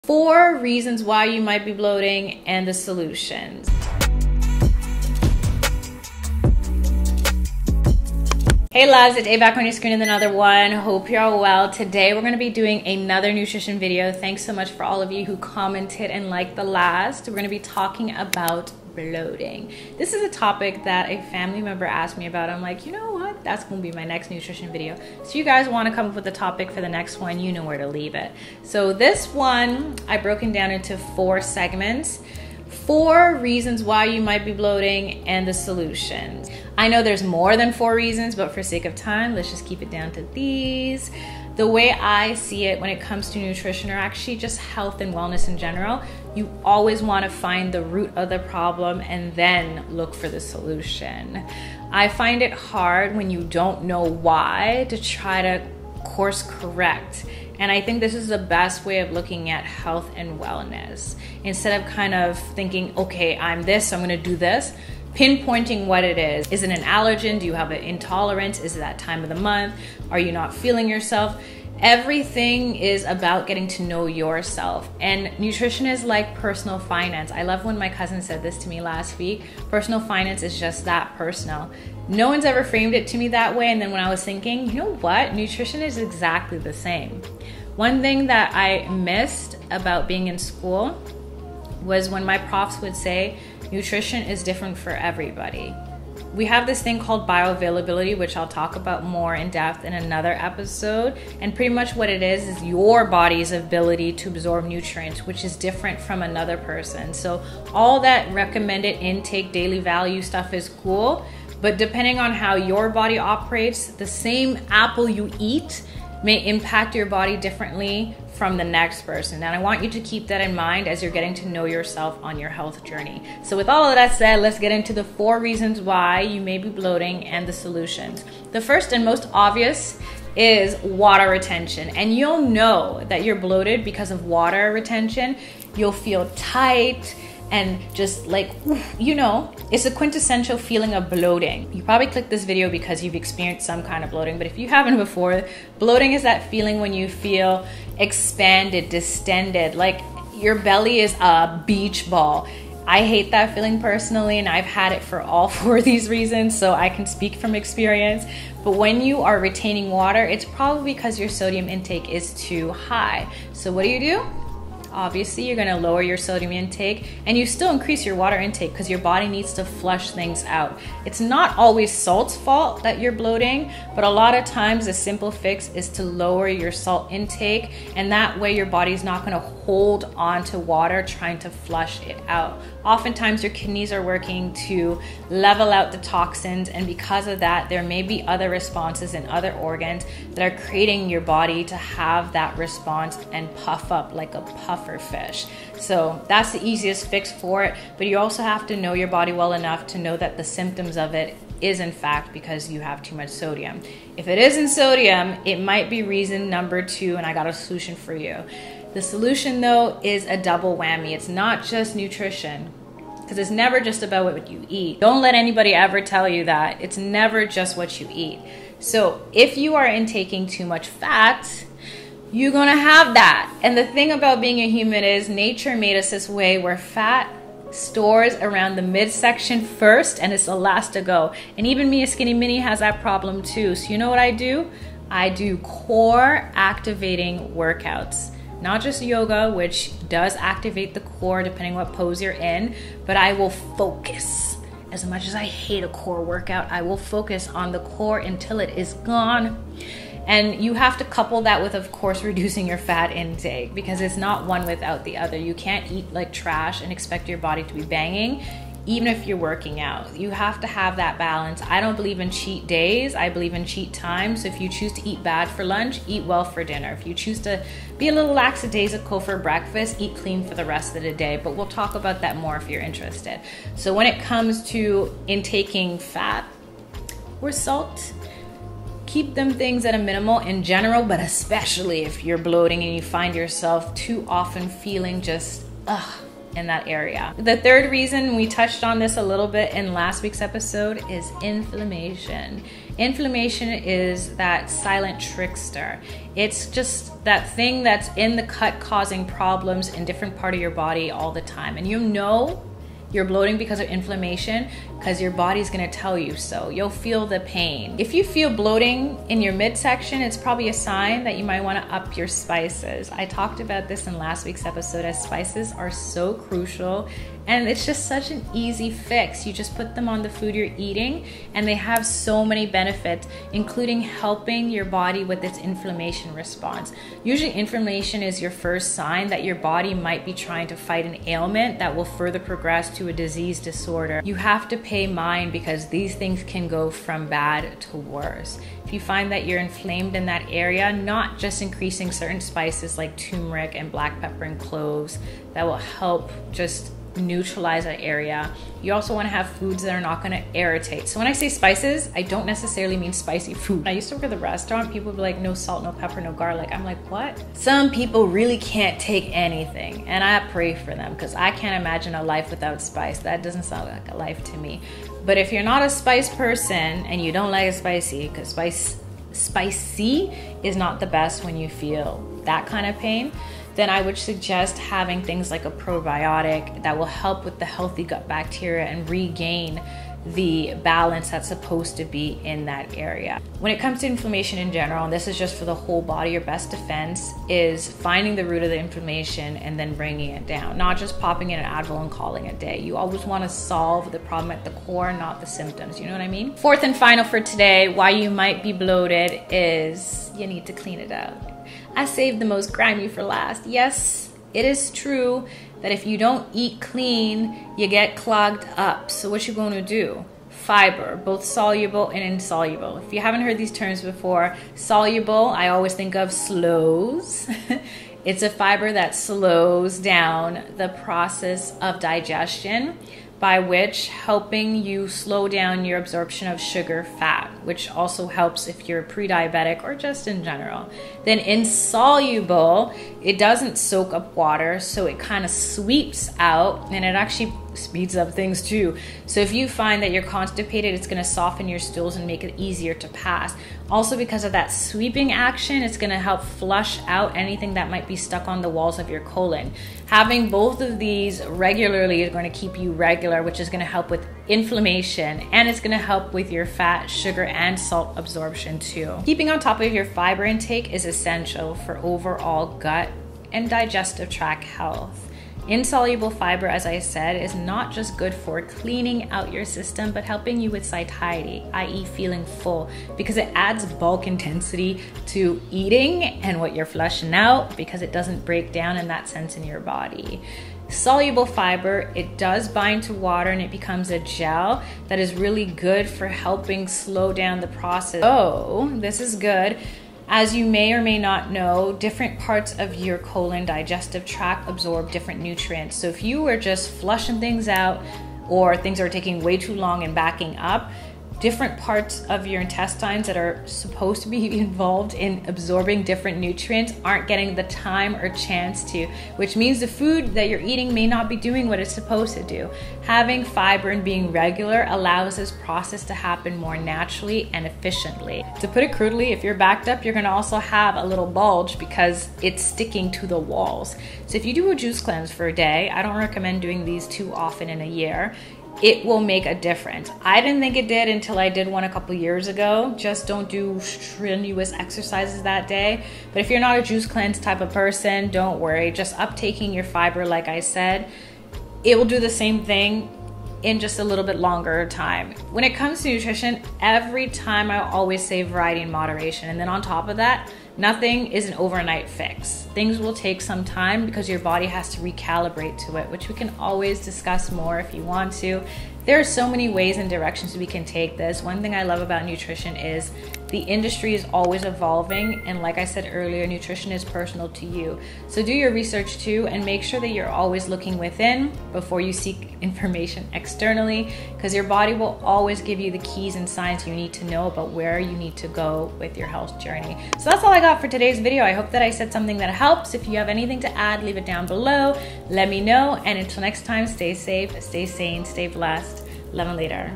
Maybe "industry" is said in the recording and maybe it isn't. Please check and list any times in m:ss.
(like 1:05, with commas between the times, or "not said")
9:23.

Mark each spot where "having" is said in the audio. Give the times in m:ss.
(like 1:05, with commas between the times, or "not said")
6:14, 7:30, 8:33.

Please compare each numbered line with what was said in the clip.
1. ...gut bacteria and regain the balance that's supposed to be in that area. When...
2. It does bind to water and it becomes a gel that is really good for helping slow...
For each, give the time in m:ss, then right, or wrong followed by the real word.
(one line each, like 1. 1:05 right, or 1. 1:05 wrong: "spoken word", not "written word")
1. 6:18 right
2. 8:02 right.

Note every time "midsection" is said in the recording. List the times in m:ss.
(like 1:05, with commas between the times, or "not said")
3:48, 5:09.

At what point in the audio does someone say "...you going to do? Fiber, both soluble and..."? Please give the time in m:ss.
6:49.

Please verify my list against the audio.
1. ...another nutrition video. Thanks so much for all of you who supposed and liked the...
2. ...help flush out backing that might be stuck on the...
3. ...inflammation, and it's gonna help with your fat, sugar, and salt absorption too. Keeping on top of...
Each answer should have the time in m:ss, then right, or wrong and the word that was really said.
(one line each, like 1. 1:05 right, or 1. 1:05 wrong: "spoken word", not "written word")
1. 0:12 wrong: "commented", not "supposed"
2. 7:26 wrong: "anything", not "backing"
3. 7:34 right.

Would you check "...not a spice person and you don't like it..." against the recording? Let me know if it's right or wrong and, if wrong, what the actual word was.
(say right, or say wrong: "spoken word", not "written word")
right.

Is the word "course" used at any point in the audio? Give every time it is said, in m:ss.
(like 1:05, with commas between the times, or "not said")
0:56, 4:11.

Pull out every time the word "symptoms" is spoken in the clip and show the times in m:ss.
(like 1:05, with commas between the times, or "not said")
3:20, 6:35.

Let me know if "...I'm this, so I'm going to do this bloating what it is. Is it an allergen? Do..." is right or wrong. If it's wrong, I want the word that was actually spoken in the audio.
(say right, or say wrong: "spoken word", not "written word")
wrong: "pinpointing", not "bloating".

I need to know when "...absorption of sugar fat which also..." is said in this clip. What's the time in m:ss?
7:05.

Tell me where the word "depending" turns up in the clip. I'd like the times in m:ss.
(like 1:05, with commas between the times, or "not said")
1:51, 4:01.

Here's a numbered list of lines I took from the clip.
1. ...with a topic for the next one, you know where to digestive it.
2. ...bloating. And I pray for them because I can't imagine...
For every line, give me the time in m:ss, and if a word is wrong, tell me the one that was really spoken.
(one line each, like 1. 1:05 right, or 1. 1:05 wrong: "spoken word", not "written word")
1. 0:26 wrong: "leave", not "digestive"
2. 5:59 wrong: "anything", not "bloating".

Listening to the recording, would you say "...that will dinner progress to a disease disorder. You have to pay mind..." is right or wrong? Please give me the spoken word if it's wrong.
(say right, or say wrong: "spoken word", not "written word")
wrong: "further", not "dinner".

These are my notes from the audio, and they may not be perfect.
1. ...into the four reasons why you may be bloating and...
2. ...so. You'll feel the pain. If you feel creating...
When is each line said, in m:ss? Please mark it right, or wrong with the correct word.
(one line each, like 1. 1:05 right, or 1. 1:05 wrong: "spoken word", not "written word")
1. 2:04 right
2. 5:06 wrong: "bloating", not "creating".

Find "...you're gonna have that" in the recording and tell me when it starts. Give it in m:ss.
3:42.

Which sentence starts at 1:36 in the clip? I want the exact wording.
We have this thing called bioavailability, which I'll talk about more in depth in another episode.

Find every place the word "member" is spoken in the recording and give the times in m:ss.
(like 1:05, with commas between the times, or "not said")
0:21.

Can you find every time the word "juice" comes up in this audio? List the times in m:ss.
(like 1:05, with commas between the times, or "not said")
8:44, 8:56.